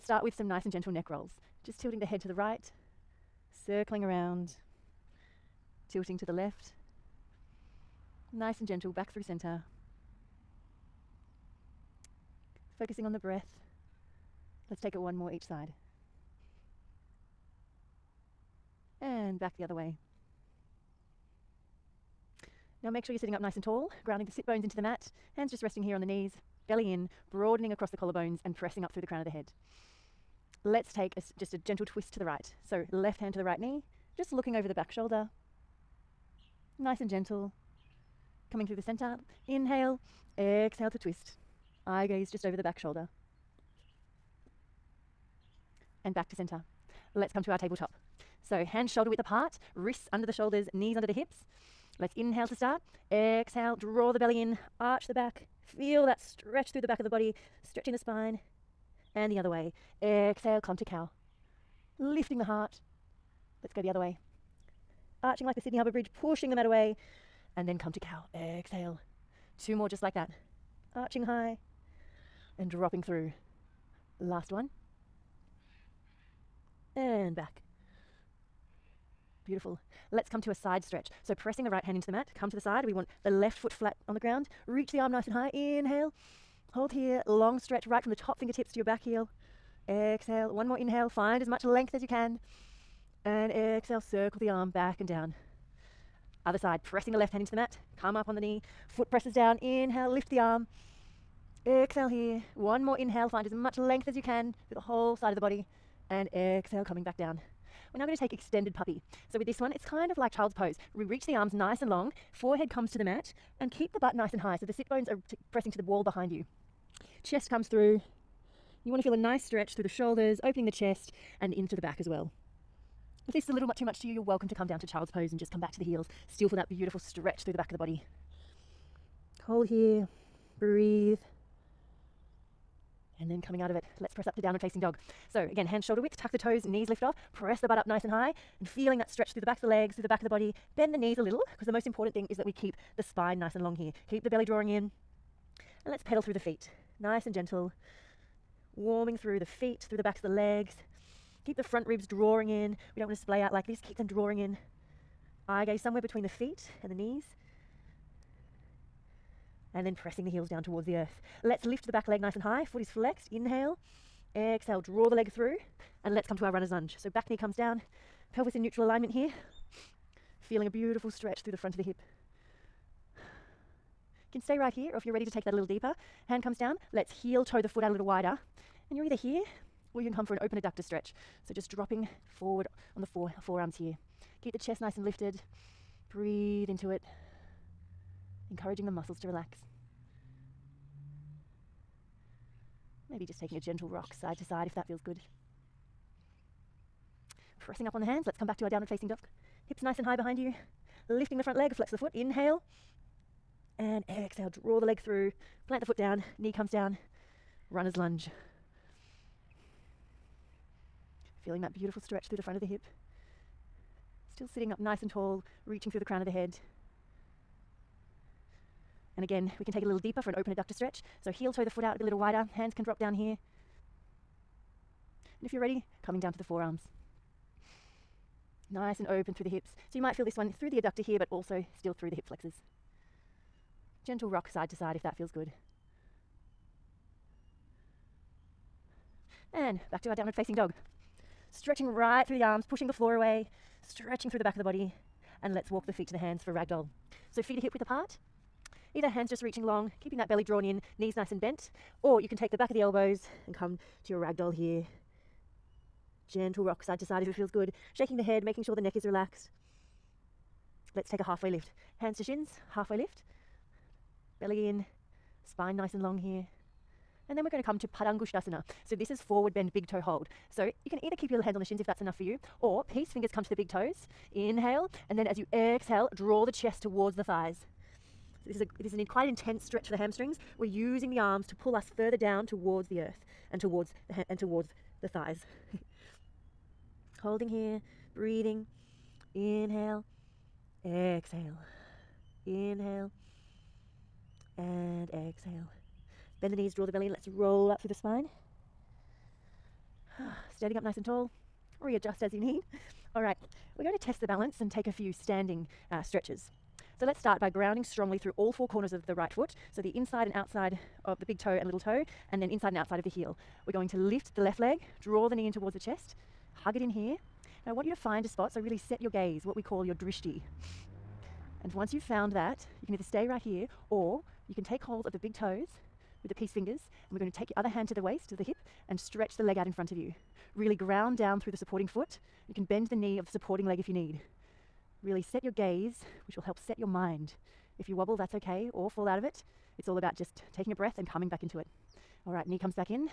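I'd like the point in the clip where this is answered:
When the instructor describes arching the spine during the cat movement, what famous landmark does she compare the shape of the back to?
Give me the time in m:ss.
1:05.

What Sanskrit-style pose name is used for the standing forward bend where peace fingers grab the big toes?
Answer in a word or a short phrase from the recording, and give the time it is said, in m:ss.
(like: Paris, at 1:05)
Padangushtasana, at 4:27.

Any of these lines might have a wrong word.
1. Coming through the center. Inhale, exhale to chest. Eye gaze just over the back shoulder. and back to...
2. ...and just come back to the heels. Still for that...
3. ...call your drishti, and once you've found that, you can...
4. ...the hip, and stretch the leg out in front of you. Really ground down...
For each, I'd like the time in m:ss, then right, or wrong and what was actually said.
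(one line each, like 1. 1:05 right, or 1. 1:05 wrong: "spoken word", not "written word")
1. 0:38 wrong: "twist", not "chest"
2. 2:05 right
3. 5:19 right
4. 5:28 right.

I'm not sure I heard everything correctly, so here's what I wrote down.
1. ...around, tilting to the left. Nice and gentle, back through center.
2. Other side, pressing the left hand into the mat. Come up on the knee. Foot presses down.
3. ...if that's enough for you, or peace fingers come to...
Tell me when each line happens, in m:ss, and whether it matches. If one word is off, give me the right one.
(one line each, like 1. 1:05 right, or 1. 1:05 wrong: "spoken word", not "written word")
1. 0:04 right
2. 1:36 right
3. 4:31 right.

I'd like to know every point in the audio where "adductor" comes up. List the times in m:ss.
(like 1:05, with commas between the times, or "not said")
3:00, 3:40, 3:50.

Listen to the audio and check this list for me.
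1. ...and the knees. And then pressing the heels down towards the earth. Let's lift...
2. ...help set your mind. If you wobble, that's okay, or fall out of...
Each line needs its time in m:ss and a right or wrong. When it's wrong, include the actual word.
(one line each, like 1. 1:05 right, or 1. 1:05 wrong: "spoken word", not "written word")
1. 2:36 right
2. 5:36 right.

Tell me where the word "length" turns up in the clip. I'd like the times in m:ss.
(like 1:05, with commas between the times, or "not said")
1:31, 1:43.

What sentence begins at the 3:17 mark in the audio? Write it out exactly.
Pressing up on the hands, let's come back to our downward facing dog.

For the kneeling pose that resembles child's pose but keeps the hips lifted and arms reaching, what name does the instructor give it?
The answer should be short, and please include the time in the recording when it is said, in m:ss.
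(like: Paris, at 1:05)
extended puppy, at 1:48.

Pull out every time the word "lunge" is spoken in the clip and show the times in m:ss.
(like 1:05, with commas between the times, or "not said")
2:46, 3:27.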